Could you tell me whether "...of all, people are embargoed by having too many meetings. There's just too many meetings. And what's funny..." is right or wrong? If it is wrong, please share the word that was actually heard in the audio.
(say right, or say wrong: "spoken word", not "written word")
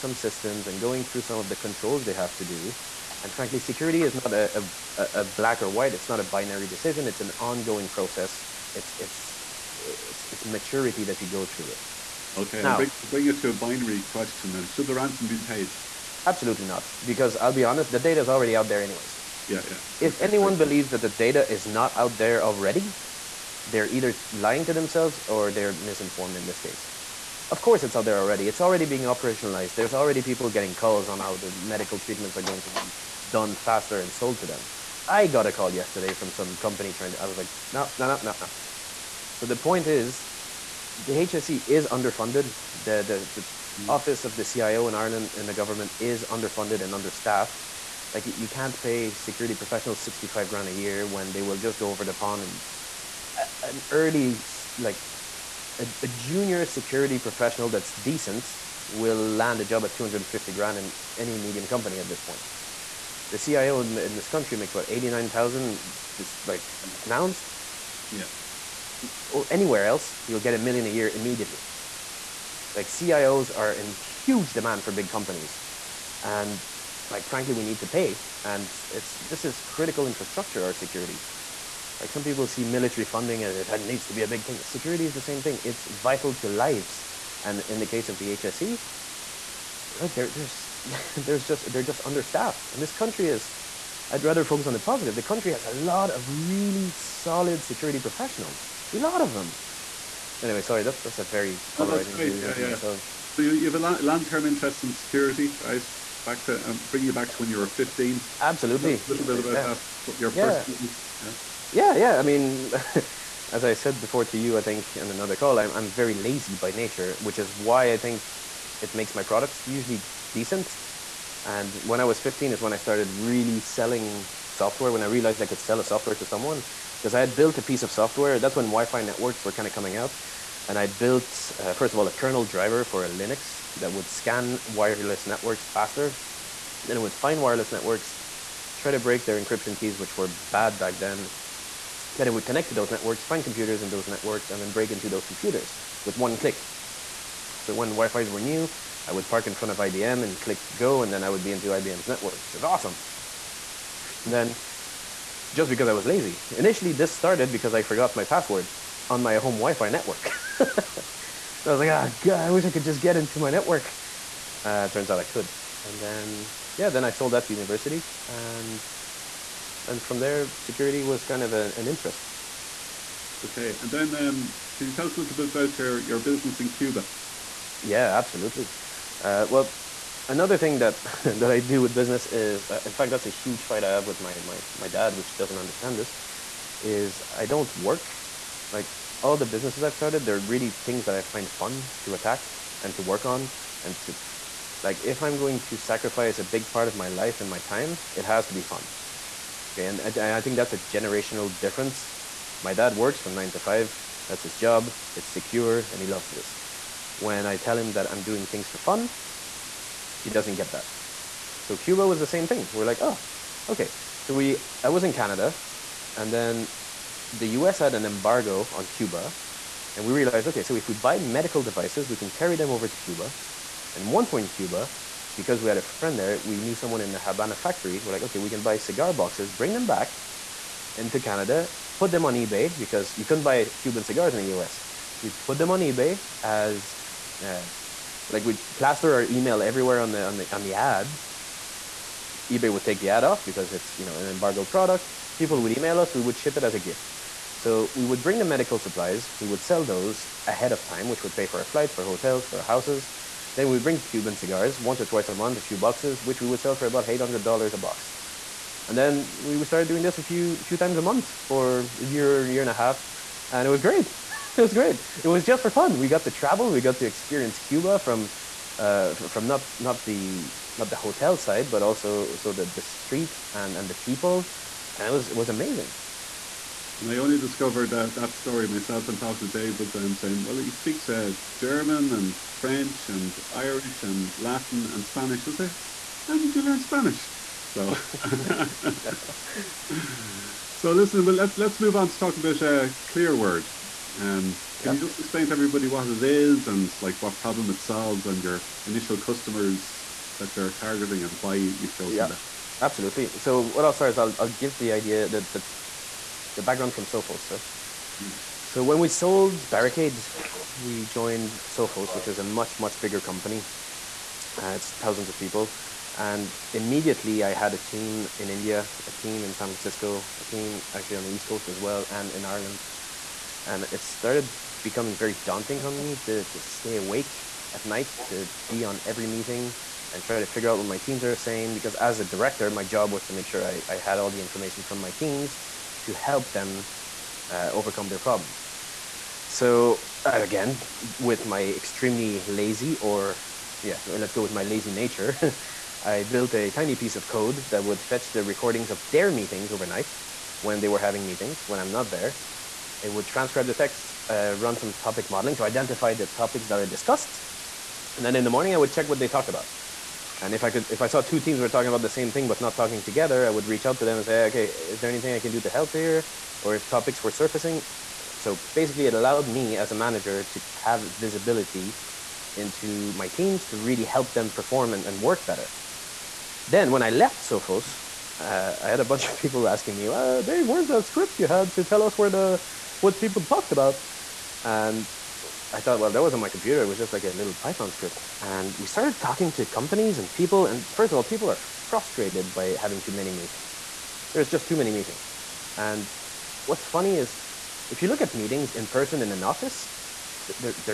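wrong: "frustrated", not "embargoed".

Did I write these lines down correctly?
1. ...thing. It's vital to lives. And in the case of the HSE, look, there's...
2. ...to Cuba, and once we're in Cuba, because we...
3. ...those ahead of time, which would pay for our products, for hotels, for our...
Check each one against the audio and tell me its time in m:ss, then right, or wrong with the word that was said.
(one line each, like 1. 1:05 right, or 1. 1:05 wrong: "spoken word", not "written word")
1. 1:25 right
2. 3:42 right
3. 4:09 wrong: "flights", not "products".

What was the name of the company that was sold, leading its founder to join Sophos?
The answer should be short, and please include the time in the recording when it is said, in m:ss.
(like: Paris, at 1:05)
Barricade, at 5:09.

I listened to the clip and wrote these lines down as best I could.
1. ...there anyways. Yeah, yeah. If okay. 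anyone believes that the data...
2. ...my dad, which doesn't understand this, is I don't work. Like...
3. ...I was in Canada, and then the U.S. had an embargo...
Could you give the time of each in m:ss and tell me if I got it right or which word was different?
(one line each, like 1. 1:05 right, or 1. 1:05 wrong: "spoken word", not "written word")
1. 0:18 right
2. 3:04 right
3. 3:34 right.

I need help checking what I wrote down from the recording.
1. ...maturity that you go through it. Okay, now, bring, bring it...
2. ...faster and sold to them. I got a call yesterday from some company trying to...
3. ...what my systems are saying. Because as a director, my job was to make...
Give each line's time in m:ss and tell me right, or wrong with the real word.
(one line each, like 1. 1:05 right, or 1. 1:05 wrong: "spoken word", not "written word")
1. 0:10 right
2. 0:33 right
3. 5:30 wrong: "teams", not "systems".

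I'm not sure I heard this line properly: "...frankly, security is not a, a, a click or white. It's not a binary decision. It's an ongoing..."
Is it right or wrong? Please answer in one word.
wrong.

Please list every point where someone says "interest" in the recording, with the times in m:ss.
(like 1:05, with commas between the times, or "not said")
1:44, 2:51.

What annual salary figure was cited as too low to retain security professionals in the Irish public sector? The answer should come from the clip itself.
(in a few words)
65 grand.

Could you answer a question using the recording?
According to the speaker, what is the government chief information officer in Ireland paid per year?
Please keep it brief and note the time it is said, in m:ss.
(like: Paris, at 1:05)
89000, at 1:04.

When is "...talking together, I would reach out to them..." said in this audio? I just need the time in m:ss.
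6:02.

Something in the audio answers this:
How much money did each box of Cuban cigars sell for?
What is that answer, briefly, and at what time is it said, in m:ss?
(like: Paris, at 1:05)
$800, at 4:17.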